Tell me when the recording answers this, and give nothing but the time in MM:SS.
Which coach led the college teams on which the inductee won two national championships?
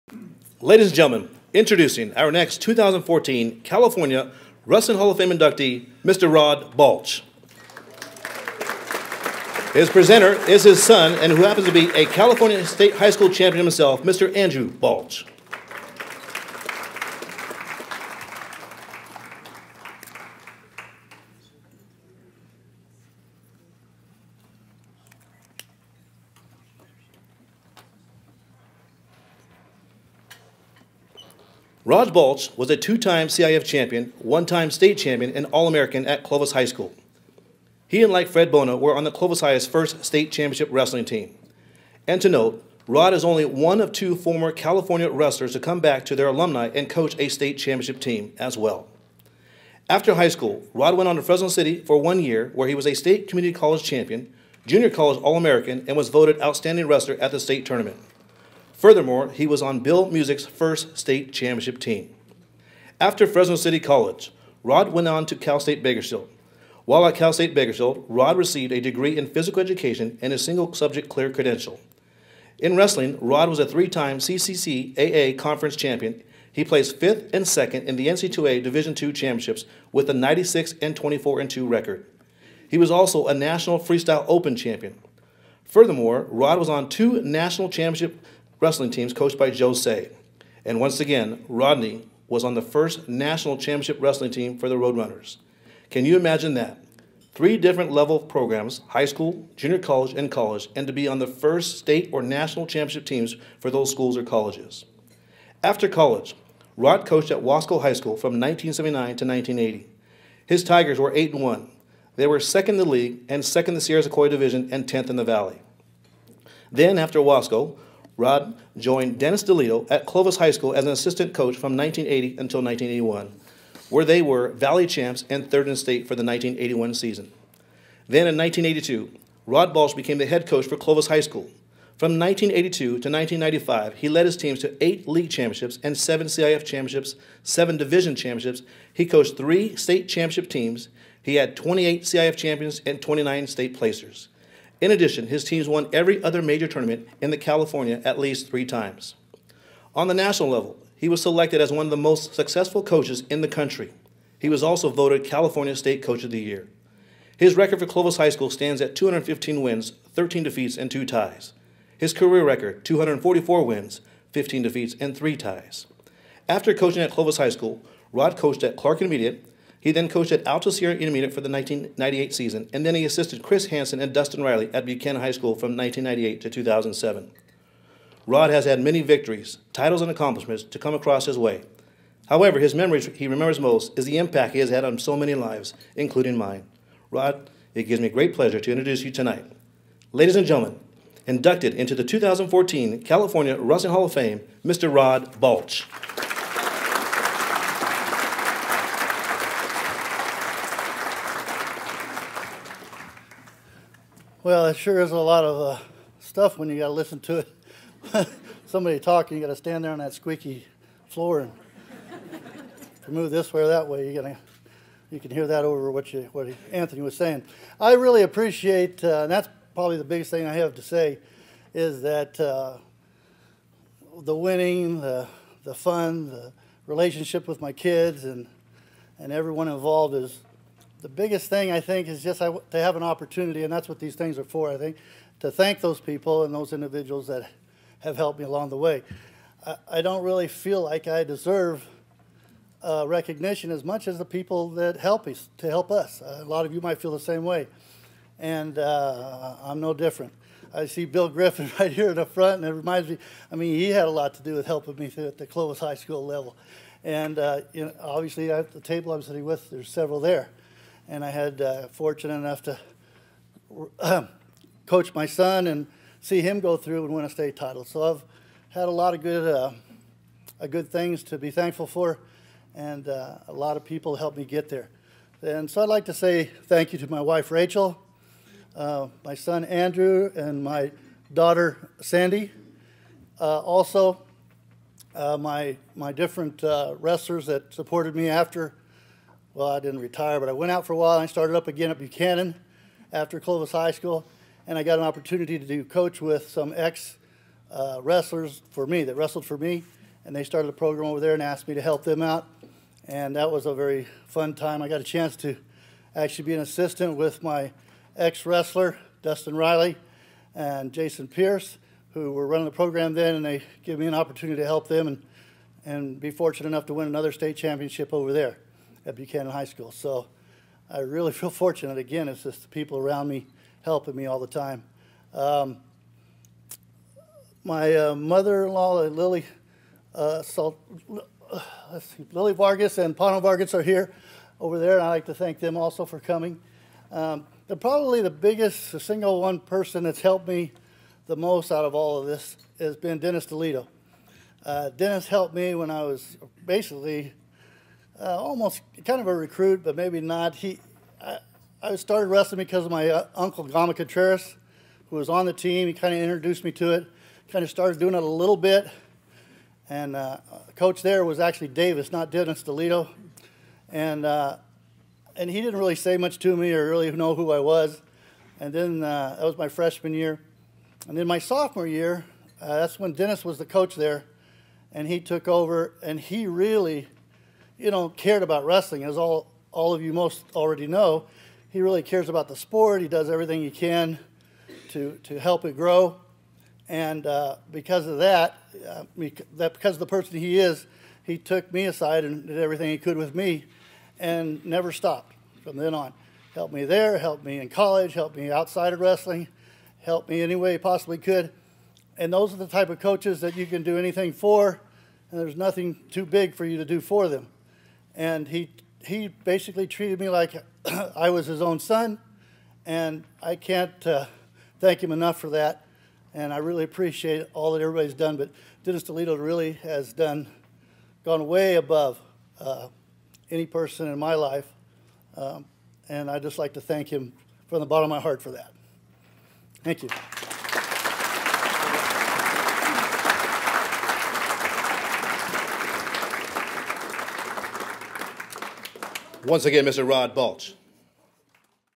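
01:29.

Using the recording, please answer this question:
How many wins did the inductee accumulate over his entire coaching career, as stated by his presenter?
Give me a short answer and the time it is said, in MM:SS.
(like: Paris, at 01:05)
244, at 02:42.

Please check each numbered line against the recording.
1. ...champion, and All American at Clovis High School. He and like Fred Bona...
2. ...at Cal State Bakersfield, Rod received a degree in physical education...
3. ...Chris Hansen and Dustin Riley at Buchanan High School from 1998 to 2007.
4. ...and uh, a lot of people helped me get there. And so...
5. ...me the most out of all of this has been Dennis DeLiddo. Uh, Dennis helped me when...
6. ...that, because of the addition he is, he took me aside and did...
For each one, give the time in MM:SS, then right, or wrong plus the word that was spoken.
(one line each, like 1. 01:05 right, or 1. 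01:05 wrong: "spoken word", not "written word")
1. 00:34 right
2. 01:07 right
3. 02:53 right
4. 04:32 right
5. 05:40 right
6. 06:29 wrong: "person", not "addition".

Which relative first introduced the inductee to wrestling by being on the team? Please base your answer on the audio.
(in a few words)
Gama Contreras.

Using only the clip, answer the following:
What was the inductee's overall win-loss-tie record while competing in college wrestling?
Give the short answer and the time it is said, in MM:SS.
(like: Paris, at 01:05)
96-24-2, at 01:20.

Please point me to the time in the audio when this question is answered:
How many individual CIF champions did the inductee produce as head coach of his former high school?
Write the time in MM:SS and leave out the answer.
02:21.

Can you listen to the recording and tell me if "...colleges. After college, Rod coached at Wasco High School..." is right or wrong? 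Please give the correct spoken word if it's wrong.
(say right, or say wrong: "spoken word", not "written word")
right.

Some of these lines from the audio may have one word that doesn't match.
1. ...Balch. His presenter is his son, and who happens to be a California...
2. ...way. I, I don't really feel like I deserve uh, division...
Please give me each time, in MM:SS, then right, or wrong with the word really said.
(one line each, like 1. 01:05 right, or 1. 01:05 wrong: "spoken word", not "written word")
1. 00:06 right
2. 03:58 wrong: "recognition", not "division".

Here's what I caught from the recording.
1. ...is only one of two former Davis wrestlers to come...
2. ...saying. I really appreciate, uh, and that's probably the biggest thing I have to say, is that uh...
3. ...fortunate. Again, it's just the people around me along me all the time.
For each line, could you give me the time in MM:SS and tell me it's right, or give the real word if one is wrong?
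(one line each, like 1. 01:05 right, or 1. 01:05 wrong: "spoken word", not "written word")
1. 00:43 wrong: "California", not "Davis"
2. 03:37 right
3. 05:21 wrong: "helping", not "along".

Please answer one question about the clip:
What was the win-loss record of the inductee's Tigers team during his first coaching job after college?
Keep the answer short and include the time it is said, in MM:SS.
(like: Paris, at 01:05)
8-1, at 01:51.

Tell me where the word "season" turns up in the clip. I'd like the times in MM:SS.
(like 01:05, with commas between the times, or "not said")
02:06, 02:52.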